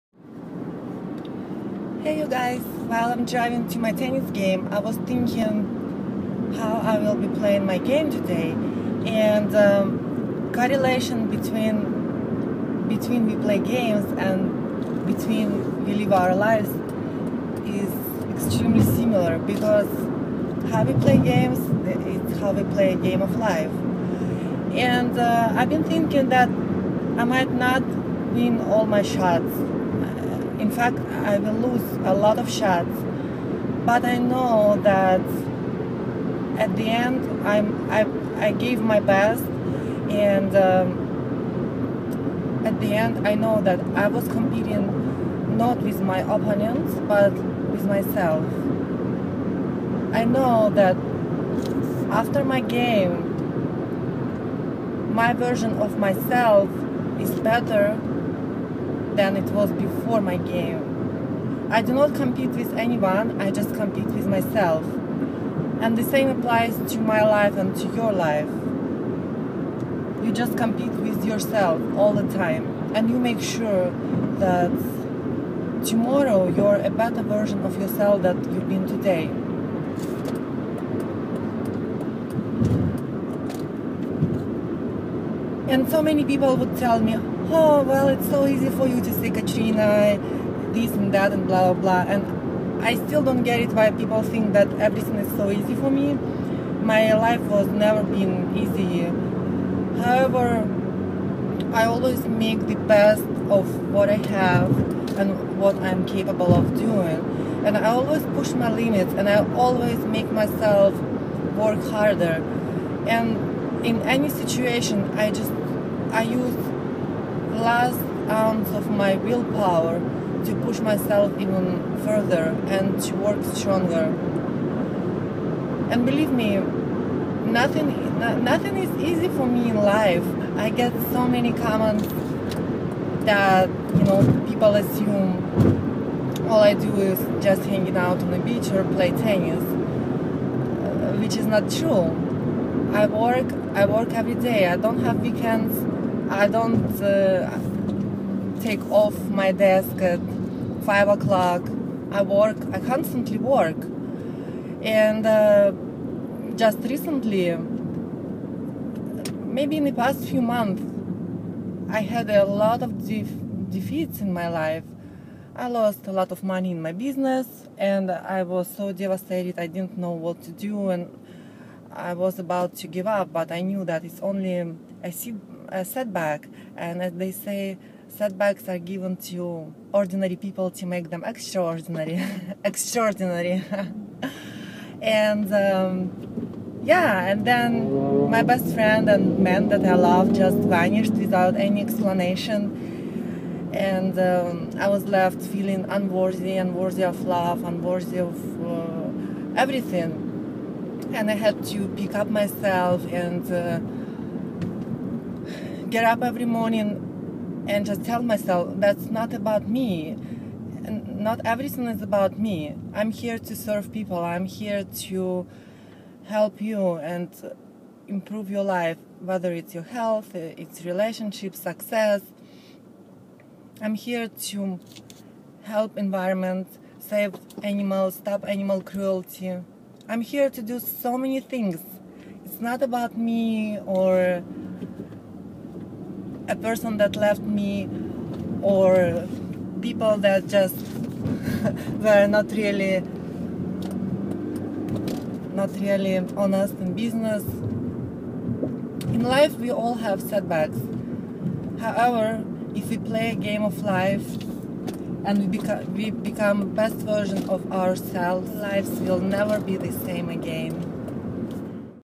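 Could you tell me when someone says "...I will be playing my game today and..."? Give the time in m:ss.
0:06.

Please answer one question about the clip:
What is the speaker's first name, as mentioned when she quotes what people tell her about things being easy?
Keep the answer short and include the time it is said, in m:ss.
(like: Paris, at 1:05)
Katrina, at 1:29.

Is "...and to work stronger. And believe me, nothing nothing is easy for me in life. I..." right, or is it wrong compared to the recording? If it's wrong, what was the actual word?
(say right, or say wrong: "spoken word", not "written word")
right.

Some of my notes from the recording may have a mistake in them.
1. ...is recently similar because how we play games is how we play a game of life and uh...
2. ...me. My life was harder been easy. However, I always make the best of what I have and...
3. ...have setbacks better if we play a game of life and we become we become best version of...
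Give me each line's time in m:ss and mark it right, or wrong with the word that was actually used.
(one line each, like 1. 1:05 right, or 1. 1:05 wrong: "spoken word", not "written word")
1. 0:17 wrong: "extremely", not "recently"
2. 1:35 wrong: "never", not "harder"
3. 4:09 wrong: "however", not "better".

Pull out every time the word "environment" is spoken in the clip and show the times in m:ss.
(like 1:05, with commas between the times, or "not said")
3:45.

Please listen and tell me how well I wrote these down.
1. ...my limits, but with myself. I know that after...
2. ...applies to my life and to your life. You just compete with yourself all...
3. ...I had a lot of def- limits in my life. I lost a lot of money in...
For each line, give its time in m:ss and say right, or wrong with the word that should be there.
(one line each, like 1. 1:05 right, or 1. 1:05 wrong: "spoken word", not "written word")
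1. 0:45 wrong: "opponents", not "limits"
2. 1:06 right
3. 2:41 wrong: "defeats", not "limits".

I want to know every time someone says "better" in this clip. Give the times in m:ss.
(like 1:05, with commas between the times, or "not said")
0:57, 1:16.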